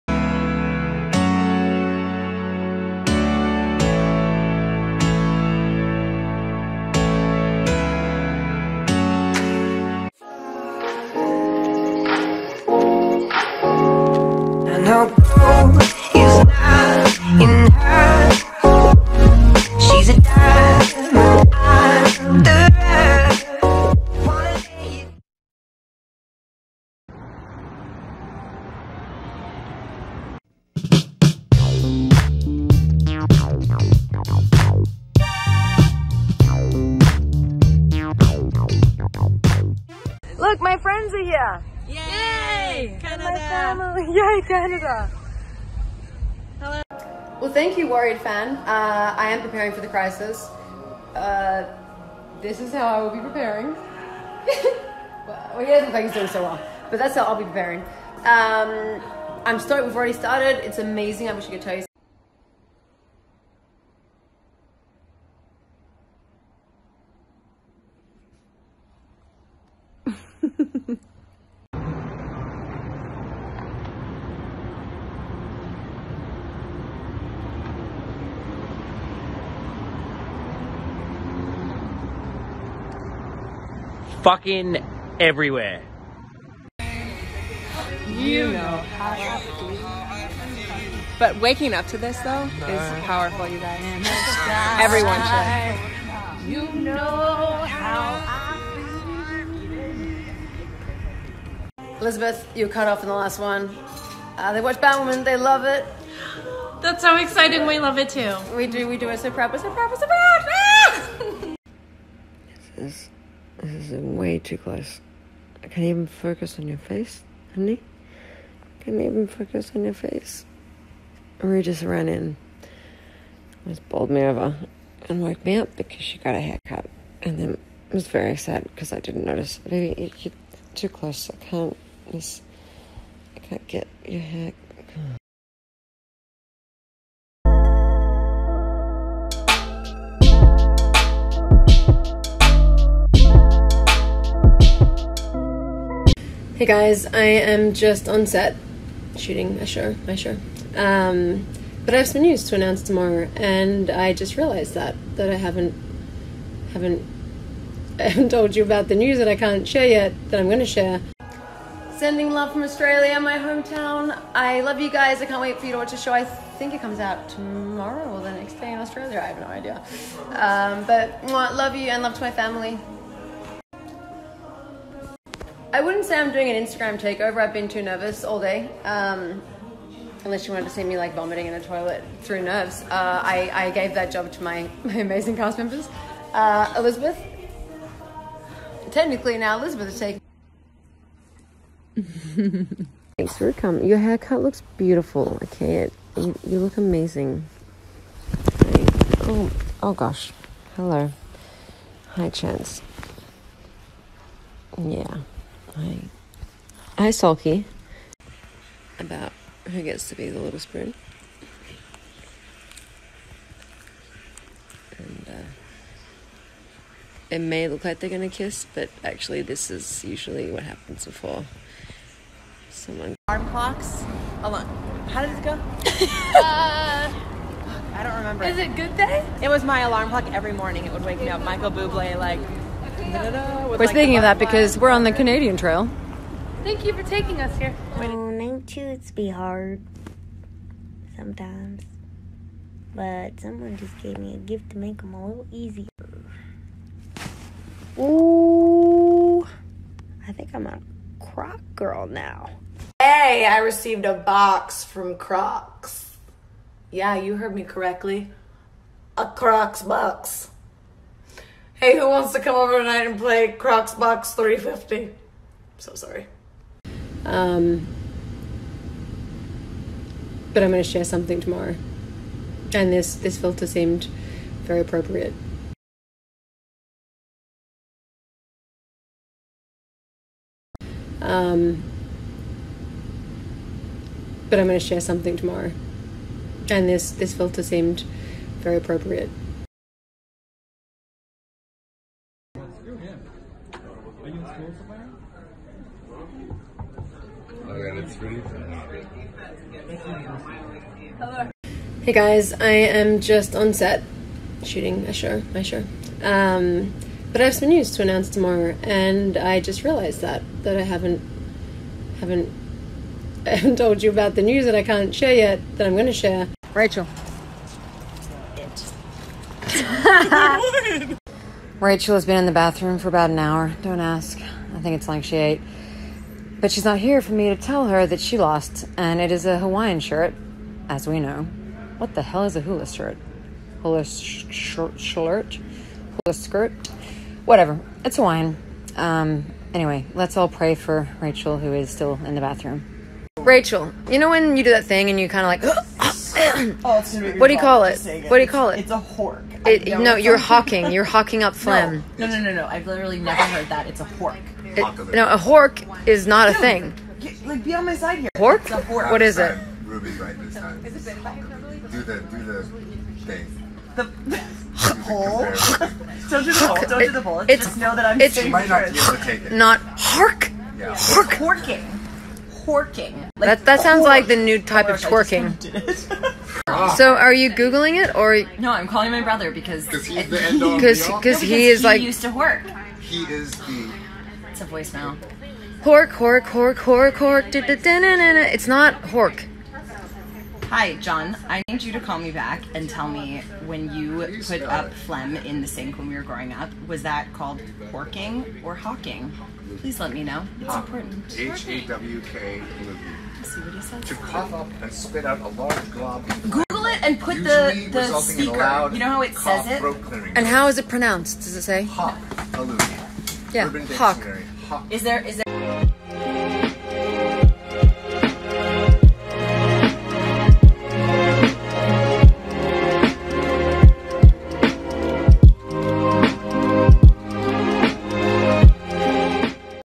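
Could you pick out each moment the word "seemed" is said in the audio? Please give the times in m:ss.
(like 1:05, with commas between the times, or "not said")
4:33, 4:47.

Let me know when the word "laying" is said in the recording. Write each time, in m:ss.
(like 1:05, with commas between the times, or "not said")
not said.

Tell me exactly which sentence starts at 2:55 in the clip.
I wouldn't say I'm doing an Instagram takeover.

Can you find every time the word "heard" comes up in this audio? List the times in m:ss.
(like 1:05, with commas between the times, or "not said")
4:17, 5:53.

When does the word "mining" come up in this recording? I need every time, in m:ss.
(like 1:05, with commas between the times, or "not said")
not said.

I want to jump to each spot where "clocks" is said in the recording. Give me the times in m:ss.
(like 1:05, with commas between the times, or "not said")
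3:43, 3:50.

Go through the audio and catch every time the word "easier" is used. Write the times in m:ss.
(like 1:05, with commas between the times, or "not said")
4:05.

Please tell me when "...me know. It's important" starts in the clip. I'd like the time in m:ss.
6:40.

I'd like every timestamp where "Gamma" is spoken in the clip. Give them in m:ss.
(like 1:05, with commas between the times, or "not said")
not said.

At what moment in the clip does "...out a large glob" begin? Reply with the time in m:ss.
6:45.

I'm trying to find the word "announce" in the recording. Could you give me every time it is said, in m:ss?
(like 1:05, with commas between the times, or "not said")
2:32, 5:08.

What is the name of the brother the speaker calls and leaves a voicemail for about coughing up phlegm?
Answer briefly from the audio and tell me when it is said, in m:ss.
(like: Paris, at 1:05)
John, at 6:30.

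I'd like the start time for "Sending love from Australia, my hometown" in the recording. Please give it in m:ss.
2:41.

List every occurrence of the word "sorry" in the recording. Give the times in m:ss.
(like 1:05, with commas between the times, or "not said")
4:25.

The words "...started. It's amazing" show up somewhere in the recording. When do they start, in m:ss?
1:00.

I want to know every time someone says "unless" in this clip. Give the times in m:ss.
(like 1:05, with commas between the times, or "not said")
3:00.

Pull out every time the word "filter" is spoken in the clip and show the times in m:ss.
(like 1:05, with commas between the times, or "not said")
4:33, 4:47.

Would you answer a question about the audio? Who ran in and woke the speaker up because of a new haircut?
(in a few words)
Rue.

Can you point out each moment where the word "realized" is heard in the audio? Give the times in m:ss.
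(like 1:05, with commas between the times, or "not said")
2:34, 5:09.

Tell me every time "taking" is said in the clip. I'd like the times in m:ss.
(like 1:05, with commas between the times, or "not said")
3:09, 3:57.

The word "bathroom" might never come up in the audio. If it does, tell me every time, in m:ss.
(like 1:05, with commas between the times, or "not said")
5:22, 5:42.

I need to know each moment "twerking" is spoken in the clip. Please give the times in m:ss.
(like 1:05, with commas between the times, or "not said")
6:15.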